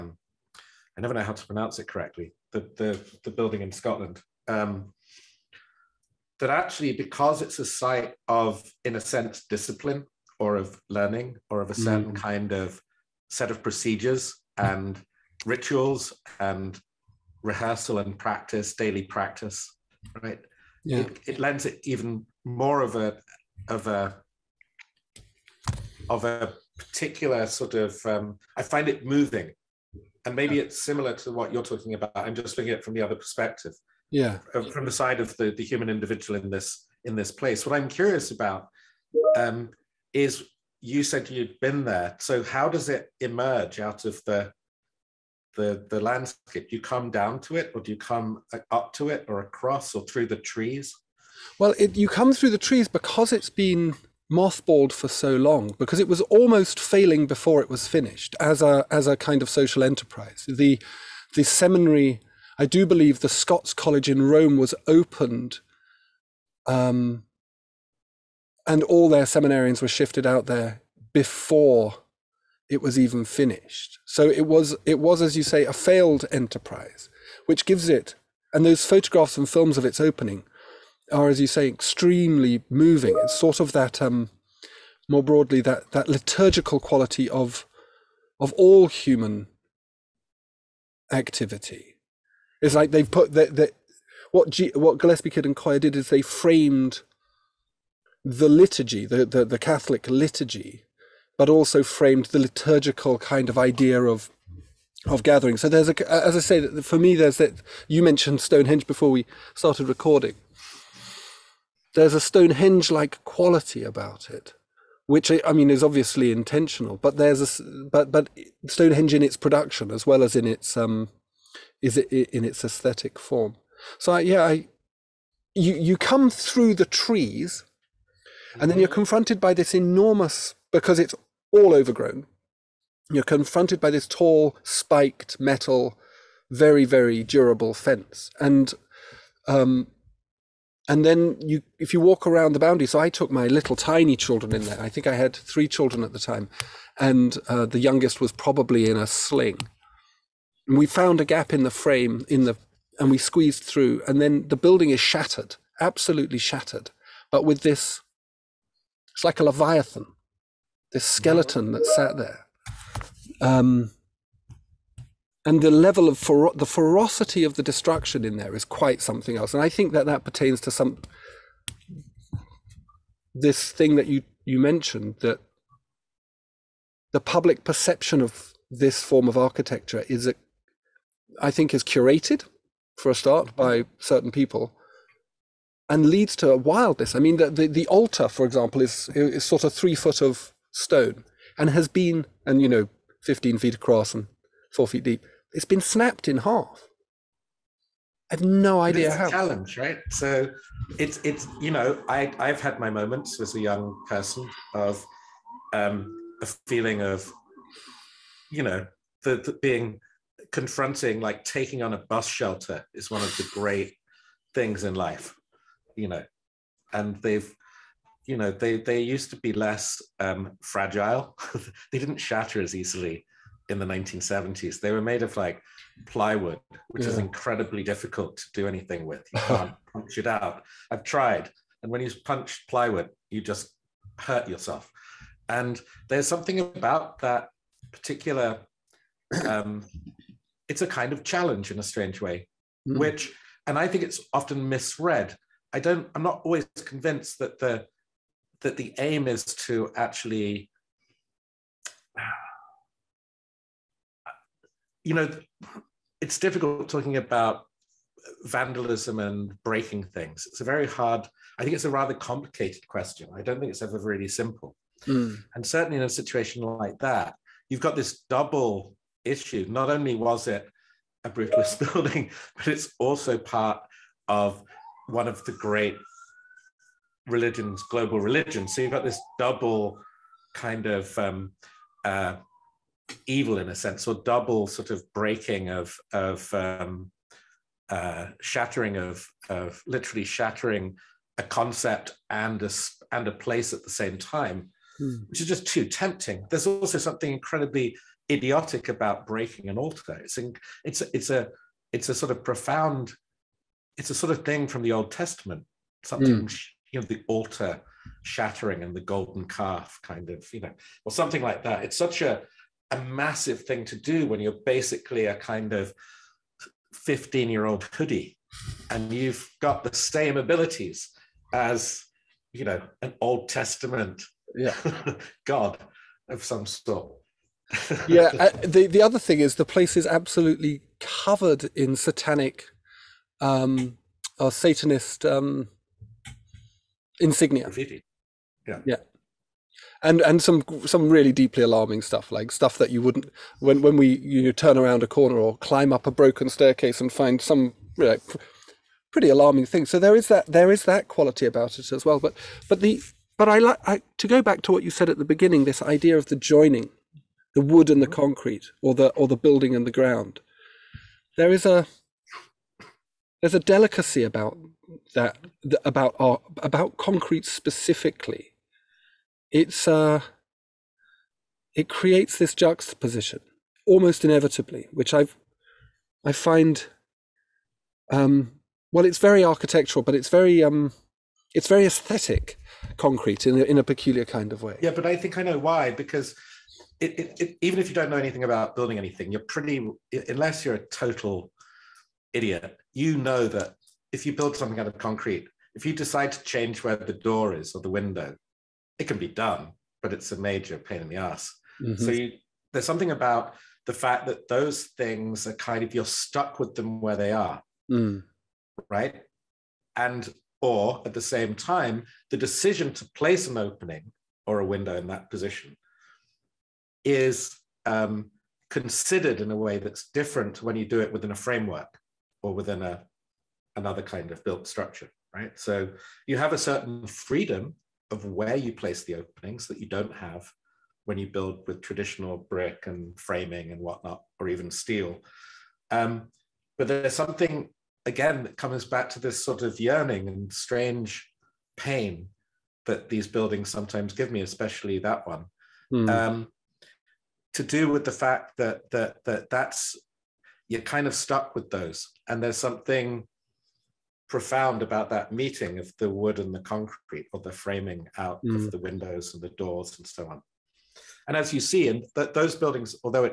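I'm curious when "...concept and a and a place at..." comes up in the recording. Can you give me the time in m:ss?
4:51.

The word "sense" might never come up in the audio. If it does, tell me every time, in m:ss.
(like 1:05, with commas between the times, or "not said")
0:09, 4:43.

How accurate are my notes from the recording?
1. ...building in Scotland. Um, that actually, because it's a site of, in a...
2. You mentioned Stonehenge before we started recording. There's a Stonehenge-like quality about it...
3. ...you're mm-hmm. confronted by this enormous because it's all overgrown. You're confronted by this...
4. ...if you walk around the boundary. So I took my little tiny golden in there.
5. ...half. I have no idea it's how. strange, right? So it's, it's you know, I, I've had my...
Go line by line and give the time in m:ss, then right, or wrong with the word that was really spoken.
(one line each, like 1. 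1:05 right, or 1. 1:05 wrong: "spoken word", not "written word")
1. 0:03 right
2. 1:47 right
3. 2:08 right
4. 2:21 wrong: "children", not "golden"
5. 3:16 wrong: "challenge", not "strange".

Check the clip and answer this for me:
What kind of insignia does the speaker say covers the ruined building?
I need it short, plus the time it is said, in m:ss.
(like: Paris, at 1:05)
Satanist, at 5:34.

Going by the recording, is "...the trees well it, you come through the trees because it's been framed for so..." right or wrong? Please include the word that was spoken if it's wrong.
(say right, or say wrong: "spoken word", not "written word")
wrong: "mothballed", not "framed".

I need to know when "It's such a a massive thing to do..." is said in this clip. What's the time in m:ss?
5:11.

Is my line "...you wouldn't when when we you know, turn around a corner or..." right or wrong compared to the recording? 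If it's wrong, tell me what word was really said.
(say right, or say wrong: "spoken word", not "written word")
right.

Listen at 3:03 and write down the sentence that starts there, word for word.
by certain people and leads to wildness.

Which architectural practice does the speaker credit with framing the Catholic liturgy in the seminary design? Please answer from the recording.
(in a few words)
Gillespie Kidd and Coia.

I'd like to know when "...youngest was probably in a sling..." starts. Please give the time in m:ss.
2:27.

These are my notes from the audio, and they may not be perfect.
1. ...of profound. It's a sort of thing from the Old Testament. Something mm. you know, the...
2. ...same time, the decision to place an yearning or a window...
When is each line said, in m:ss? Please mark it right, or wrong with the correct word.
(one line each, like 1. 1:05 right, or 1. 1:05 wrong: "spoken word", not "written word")
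1. 5:02 right
2. 6:51 wrong: "opening", not "yearning".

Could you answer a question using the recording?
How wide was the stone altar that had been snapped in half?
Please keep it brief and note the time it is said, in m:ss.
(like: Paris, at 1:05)
15 feet, at 3:13.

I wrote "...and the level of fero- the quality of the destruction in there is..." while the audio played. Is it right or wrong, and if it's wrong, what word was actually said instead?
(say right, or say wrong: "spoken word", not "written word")
wrong: "ferocity", not "quality".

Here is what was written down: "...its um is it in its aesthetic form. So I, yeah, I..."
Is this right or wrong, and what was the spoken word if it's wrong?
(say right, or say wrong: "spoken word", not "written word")
right.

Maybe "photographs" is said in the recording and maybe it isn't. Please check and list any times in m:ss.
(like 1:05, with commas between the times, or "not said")
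1:18.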